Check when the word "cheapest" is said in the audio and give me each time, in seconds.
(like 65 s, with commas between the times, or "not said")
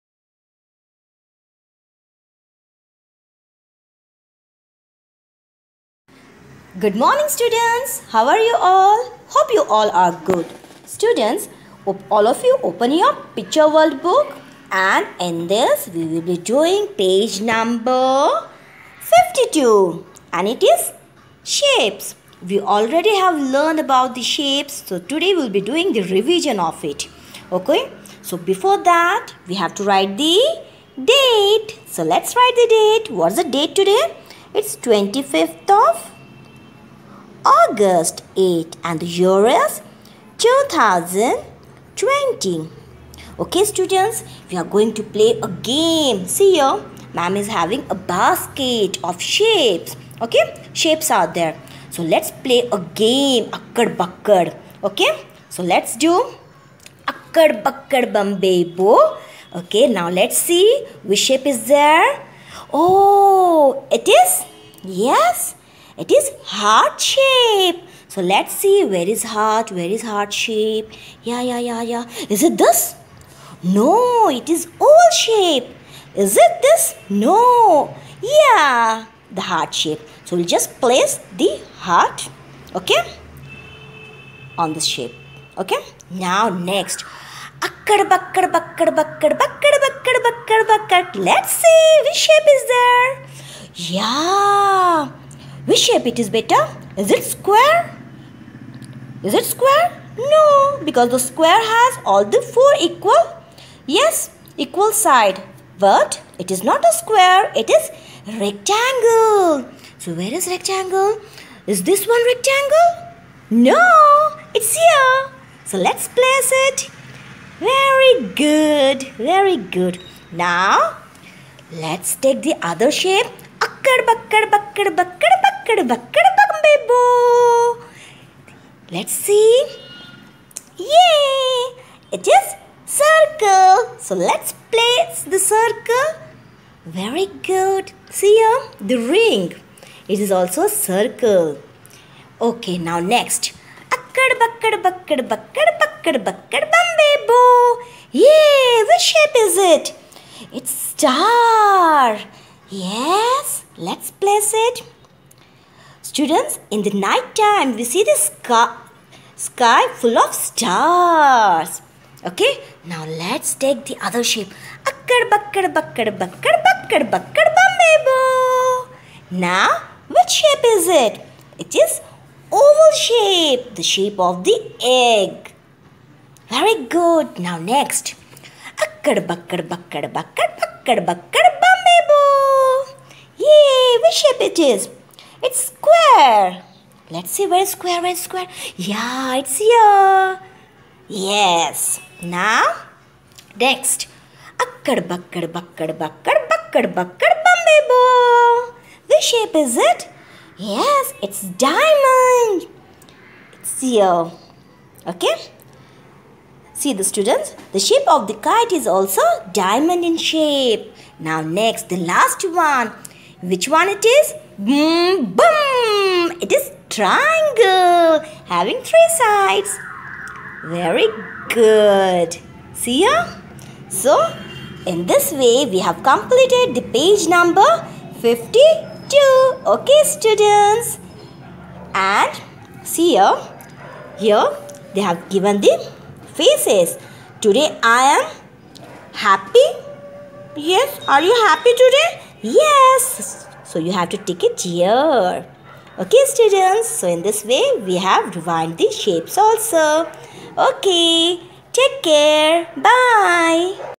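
not said.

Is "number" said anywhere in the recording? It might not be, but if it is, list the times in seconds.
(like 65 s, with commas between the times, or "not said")
17 s, 227 s.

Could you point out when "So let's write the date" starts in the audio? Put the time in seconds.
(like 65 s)
31 s.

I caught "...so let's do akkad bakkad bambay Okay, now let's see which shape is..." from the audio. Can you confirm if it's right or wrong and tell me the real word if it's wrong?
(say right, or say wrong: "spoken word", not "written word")
right.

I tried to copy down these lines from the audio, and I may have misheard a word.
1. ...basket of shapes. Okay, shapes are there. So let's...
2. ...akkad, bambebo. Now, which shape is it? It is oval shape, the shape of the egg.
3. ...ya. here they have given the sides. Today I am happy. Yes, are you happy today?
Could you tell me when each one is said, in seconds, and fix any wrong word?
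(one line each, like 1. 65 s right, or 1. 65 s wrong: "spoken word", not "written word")
1. 47 s right
2. 167 s wrong: "bakkad", not "akkad"
3. 233 s wrong: "faces", not "sides".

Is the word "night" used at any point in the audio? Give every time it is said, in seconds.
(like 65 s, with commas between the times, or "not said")
157 s.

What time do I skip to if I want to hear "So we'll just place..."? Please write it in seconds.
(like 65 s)
80 s.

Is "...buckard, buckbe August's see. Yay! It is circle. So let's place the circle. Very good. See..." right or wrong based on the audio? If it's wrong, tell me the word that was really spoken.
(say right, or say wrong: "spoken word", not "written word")
wrong: "Let", not "August".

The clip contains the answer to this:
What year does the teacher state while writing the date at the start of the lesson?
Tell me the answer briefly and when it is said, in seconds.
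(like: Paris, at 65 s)
2020, at 40 s.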